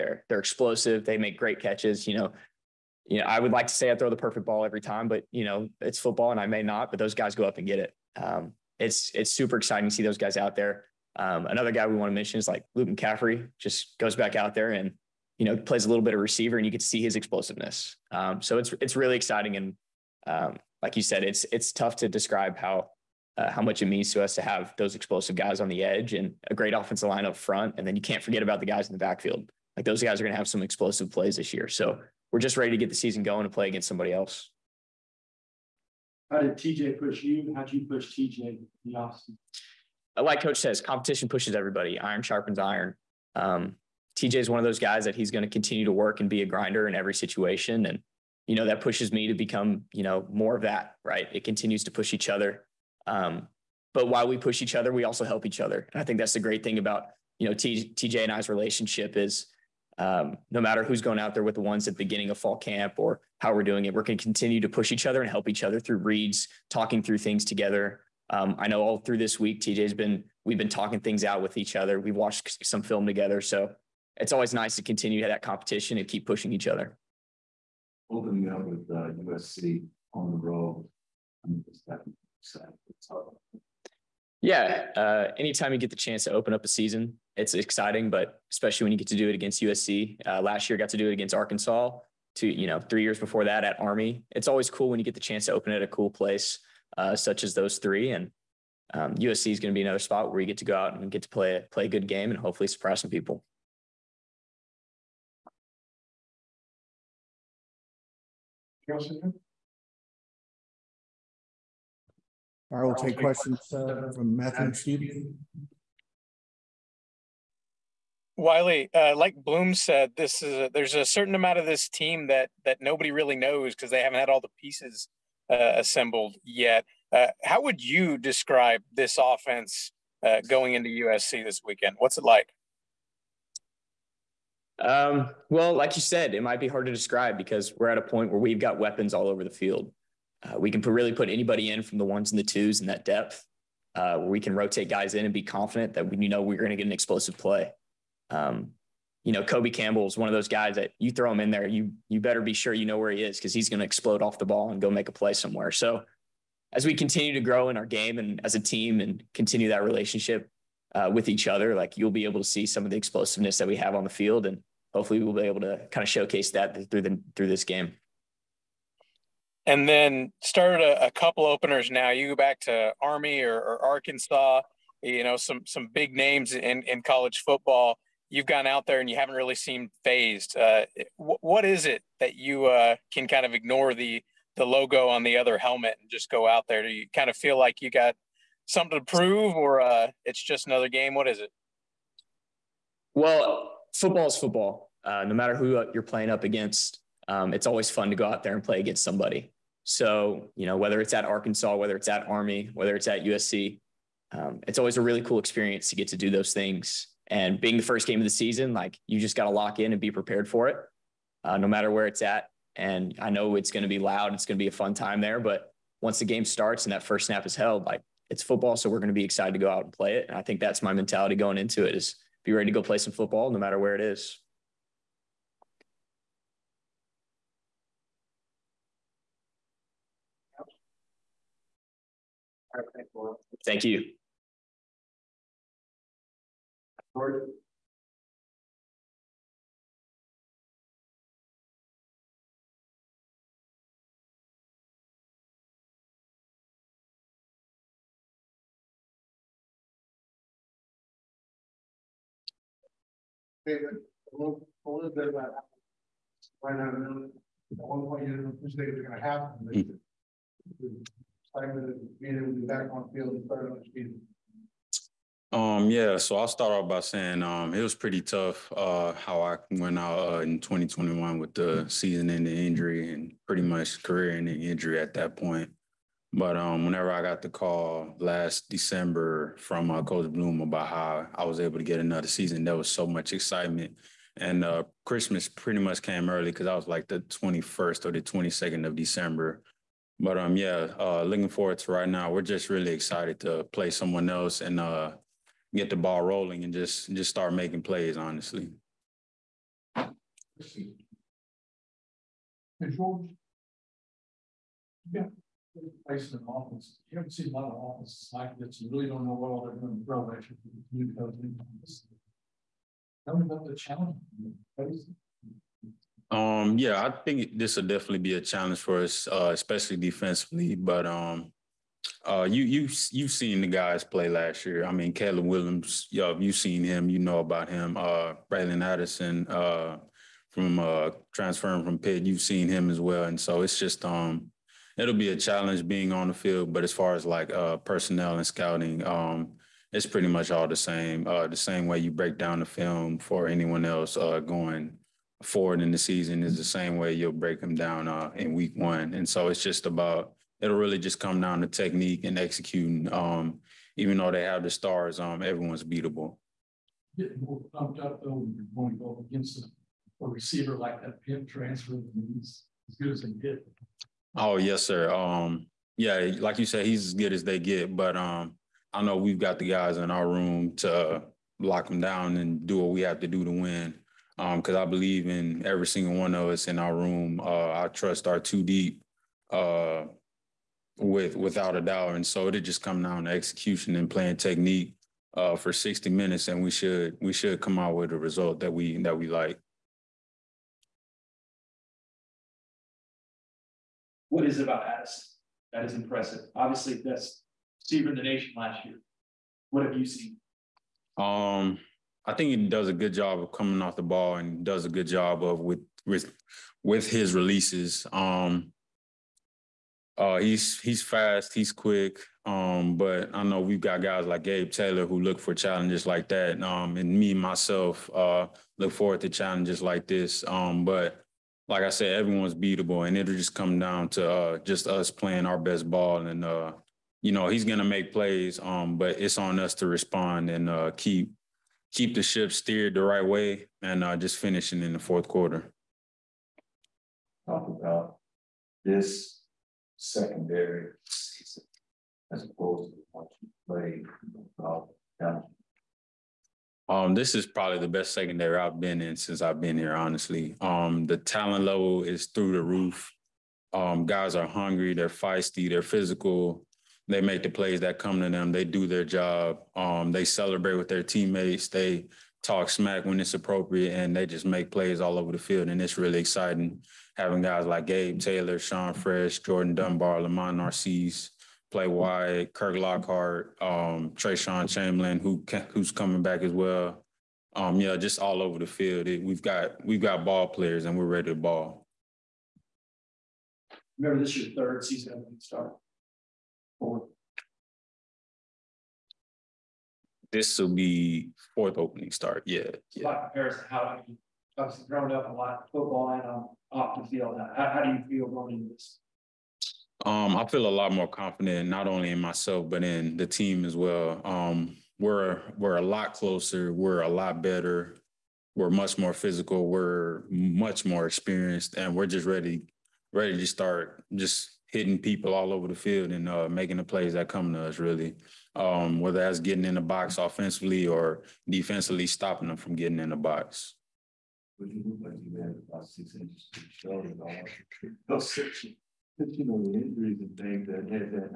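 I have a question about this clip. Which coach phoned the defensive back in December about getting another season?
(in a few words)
Coach Bloom.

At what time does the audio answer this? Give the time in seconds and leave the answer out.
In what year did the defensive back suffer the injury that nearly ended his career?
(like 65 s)
270 s.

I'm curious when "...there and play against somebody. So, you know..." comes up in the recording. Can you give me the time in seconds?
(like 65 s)
198 s.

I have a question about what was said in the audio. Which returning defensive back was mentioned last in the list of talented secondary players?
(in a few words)
Trayshawn Chamberlain.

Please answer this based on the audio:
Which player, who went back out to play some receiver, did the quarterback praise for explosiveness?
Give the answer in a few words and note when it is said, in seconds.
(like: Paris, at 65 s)
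Luke McCaffrey, at 12 s.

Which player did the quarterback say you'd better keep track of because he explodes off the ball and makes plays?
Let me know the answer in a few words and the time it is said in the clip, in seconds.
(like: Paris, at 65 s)
Kobe Campbell, at 149 s.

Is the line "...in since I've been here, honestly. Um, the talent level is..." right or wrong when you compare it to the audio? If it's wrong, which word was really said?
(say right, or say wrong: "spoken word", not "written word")
right.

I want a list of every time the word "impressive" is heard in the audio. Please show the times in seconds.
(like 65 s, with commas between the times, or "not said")
395 s.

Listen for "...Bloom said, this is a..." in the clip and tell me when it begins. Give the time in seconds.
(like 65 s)
119 s.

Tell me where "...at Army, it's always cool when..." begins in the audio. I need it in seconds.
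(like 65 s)
93 s.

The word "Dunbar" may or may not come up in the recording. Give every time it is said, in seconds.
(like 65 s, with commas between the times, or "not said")
469 s.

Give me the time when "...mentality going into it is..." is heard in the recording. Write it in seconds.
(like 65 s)
220 s.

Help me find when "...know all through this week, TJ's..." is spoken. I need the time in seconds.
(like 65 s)
68 s.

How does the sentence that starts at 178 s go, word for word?
You've gone out there and you haven't really seemed phased.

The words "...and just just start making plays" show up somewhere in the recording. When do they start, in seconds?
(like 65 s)
296 s.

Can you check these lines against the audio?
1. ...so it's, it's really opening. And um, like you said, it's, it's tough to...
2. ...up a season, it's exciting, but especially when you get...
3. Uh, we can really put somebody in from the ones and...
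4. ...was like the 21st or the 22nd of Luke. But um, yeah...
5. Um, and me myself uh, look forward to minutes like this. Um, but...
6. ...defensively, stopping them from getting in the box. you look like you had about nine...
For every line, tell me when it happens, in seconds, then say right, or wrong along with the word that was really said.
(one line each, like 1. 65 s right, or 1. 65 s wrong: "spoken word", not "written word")
1. 18 s wrong: "exciting", not "opening"
2. 86 s right
3. 140 s wrong: "anybody", not "somebody"
4. 286 s wrong: "December", not "Luke"
5. 416 s wrong: "challenges", not "minutes"
6. 521 s wrong: "six", not "nine".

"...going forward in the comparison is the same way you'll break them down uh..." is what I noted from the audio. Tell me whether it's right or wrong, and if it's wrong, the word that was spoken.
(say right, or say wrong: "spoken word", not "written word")
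wrong: "season", not "comparison".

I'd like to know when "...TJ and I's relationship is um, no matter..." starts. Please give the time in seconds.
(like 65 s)
57 s.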